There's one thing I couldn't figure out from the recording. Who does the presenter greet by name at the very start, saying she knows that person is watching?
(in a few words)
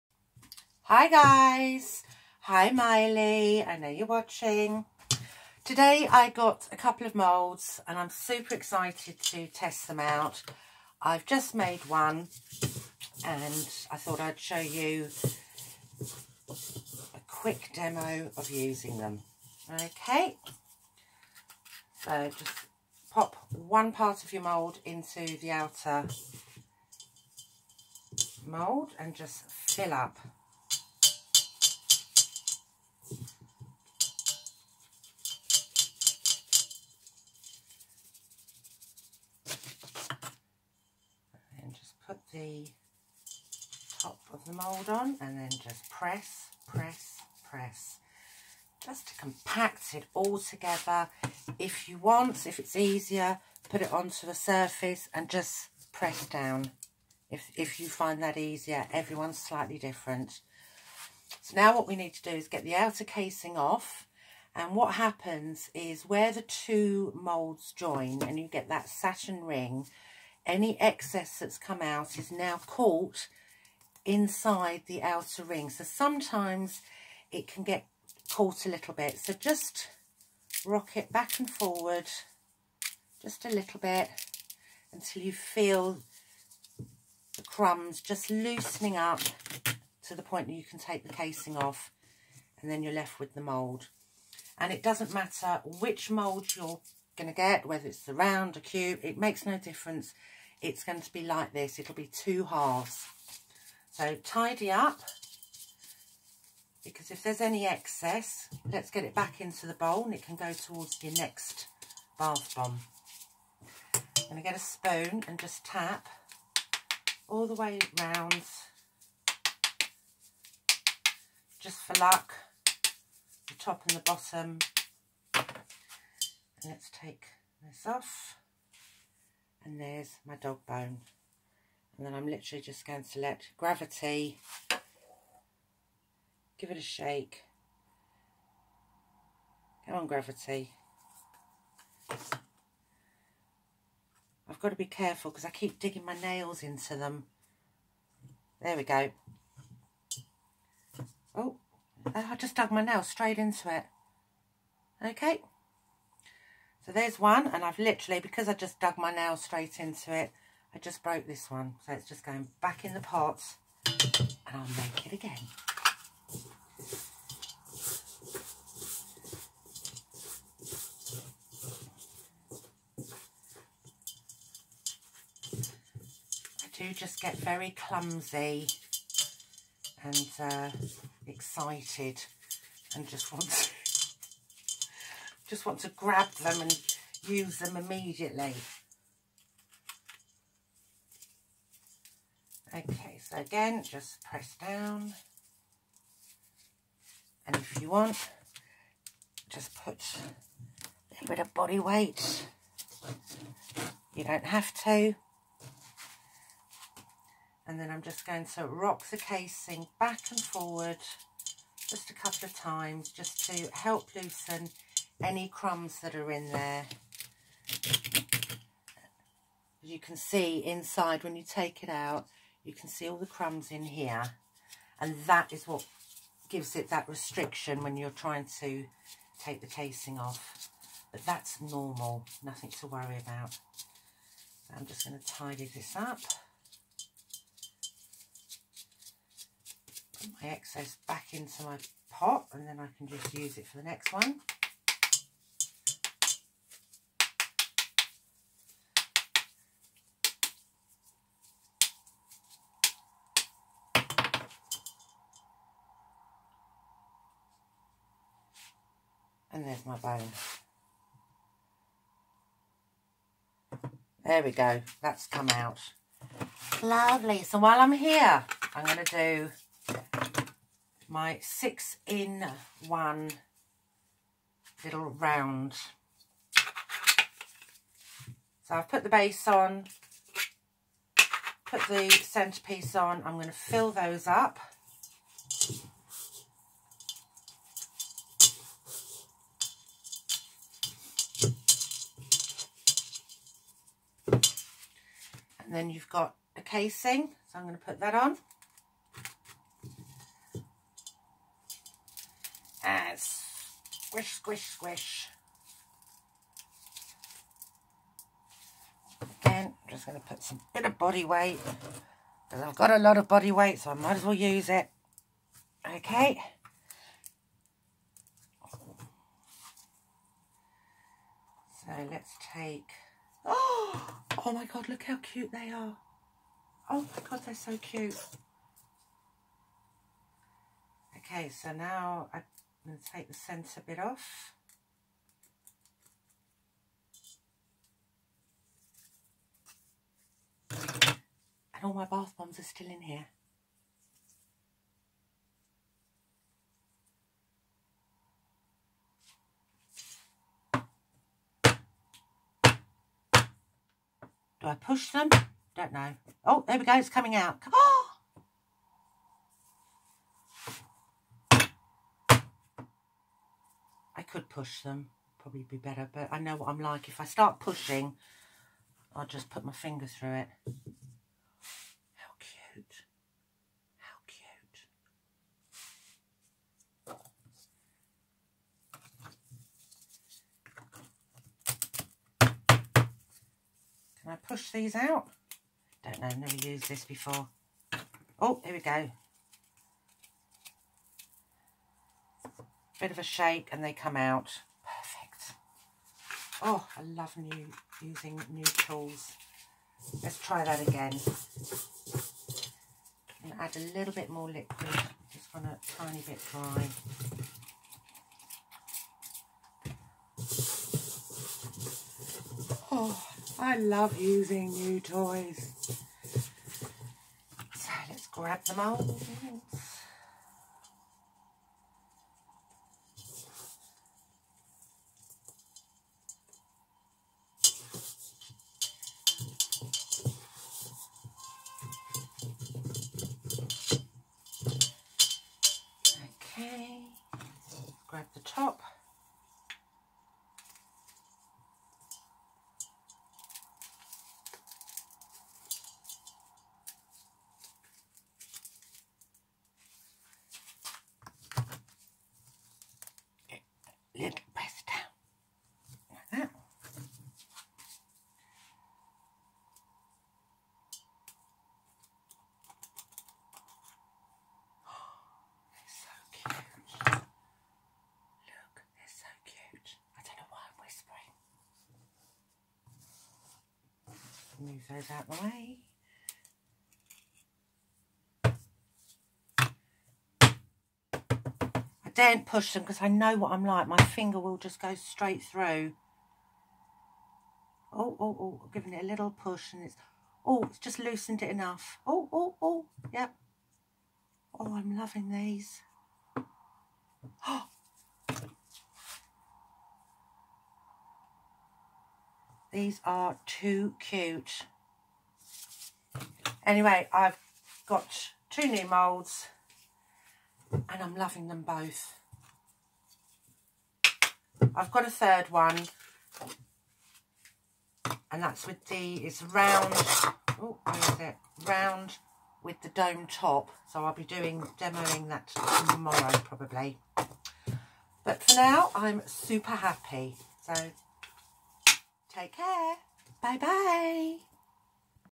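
Miley.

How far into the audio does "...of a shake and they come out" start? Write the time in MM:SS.
06:33.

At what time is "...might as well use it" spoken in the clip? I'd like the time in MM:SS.
05:13.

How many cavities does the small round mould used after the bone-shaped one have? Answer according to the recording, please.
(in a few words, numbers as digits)
6.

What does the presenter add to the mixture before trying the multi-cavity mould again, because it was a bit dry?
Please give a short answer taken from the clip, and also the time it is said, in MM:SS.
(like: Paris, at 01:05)
liquid, at 06:44.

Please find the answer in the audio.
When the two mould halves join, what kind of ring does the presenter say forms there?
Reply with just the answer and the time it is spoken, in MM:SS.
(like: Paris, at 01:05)
satin ring, at 01:08.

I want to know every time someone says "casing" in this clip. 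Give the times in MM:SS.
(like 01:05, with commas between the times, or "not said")
01:03, 01:31, 03:29, 03:49, 04:56.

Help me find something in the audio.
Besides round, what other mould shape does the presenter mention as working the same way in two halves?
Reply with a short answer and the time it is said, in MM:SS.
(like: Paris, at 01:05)
cube, at 01:38.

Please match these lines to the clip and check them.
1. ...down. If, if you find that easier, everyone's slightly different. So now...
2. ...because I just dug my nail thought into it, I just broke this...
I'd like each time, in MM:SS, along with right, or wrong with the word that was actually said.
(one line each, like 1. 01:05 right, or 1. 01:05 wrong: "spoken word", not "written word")
1. 00:56 right
2. 02:38 wrong: "straight", not "thought".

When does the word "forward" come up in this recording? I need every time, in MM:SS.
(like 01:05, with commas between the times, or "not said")
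01:21, 03:30.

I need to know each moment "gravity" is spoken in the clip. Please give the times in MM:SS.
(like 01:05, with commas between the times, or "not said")
02:13, 02:20.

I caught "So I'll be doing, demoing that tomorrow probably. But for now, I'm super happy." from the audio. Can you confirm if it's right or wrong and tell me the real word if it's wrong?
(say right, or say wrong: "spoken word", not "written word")
right.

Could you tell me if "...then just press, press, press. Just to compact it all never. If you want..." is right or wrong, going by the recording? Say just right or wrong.
wrong.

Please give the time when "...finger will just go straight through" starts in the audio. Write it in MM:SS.
08:03.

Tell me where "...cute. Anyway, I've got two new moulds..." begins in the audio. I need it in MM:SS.
08:23.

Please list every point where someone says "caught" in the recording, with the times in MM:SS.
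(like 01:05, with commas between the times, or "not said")
01:12, 01:18.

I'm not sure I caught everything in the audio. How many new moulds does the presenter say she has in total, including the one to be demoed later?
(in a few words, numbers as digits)
3.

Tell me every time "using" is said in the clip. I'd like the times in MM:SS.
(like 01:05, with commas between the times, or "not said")
00:18, 06:38, 06:54.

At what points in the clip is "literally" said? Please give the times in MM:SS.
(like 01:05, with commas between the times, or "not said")
02:12, 02:37.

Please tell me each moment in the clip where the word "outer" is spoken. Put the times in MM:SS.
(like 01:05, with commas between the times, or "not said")
00:25, 01:02, 01:15.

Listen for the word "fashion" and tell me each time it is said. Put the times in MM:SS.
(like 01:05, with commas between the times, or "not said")
not said.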